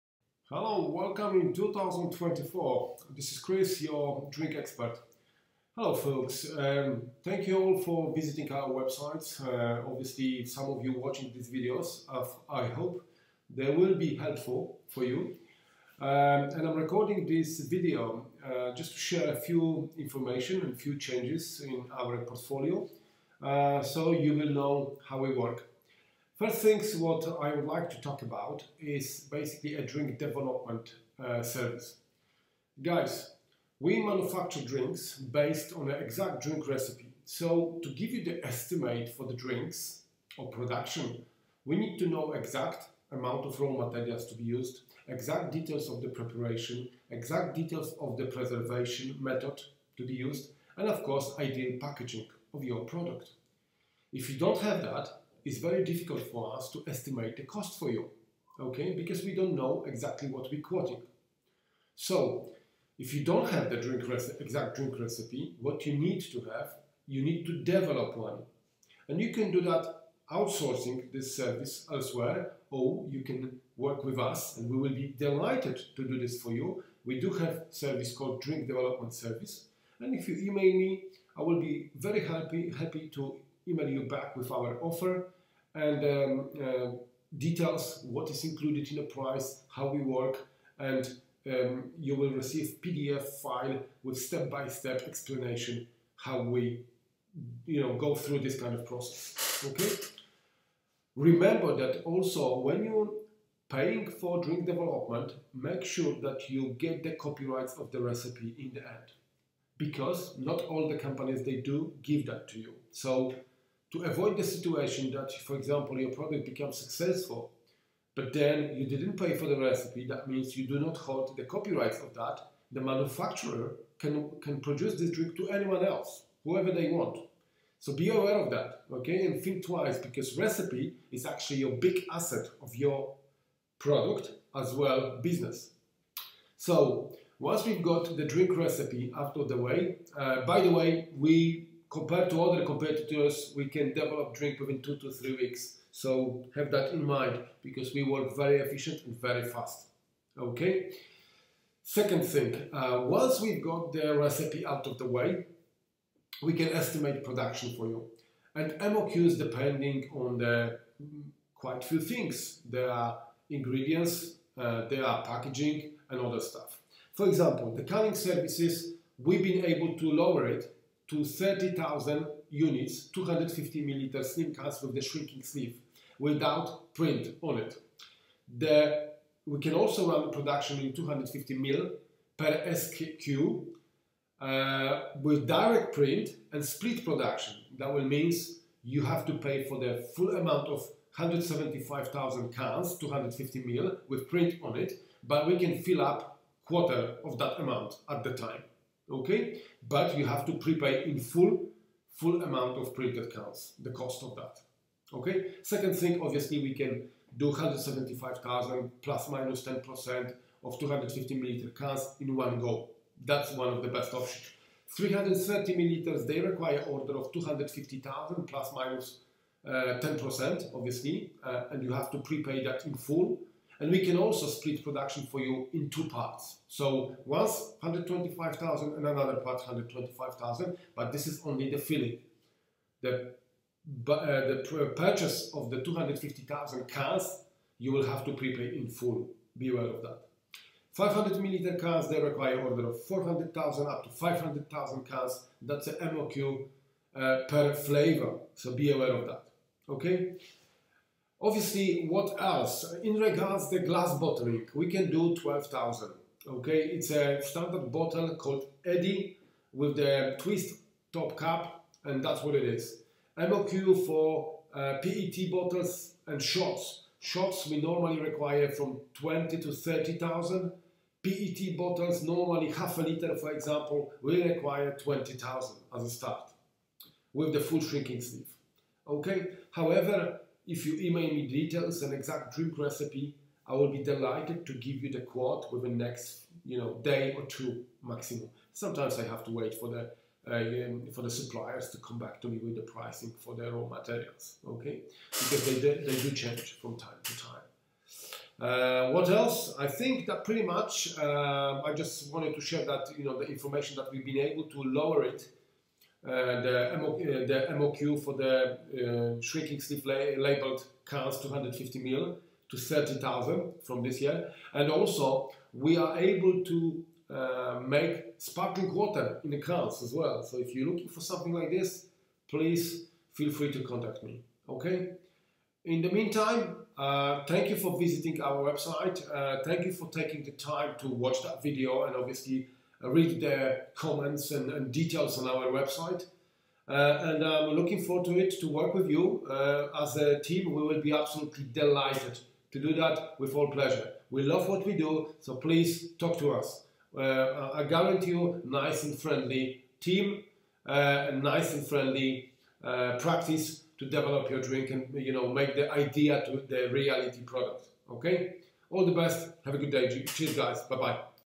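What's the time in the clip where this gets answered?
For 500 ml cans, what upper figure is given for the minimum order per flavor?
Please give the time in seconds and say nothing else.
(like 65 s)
244 s.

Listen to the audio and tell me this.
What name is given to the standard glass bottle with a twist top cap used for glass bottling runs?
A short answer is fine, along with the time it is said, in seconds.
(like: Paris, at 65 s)
Eddy, at 258 s.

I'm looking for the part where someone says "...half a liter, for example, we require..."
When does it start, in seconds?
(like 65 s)
272 s.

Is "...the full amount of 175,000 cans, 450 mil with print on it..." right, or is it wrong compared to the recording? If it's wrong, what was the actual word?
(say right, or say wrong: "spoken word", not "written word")
wrong: "250", not "450".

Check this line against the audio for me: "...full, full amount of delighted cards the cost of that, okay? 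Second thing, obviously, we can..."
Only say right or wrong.
wrong.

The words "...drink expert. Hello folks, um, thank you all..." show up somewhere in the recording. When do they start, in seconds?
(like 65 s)
4 s.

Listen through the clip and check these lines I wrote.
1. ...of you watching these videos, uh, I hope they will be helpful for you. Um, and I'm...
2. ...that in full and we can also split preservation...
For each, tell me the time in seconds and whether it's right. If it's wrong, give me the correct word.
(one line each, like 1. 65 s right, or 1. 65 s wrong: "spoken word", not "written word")
1. 10 s right
2. 222 s wrong: "production", not "preservation".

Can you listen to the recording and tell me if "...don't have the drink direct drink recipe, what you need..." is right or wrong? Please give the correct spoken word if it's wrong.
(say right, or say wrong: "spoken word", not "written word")
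wrong: "exact", not "direct".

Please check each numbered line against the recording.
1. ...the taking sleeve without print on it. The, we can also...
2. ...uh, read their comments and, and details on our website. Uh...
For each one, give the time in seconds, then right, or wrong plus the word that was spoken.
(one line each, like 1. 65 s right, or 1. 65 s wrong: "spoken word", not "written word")
1. 174 s wrong: "shrinking", not "taking"
2. 333 s right.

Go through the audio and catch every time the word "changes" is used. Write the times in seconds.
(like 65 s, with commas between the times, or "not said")
20 s, 296 s.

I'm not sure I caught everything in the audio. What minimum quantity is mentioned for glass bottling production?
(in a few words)
12,000.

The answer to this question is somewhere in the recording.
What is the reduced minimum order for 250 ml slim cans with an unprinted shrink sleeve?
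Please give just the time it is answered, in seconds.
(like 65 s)
171 s.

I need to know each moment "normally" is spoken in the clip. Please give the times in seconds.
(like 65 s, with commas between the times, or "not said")
267 s, 272 s.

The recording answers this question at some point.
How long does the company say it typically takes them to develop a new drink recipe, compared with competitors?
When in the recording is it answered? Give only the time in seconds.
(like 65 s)
144 s.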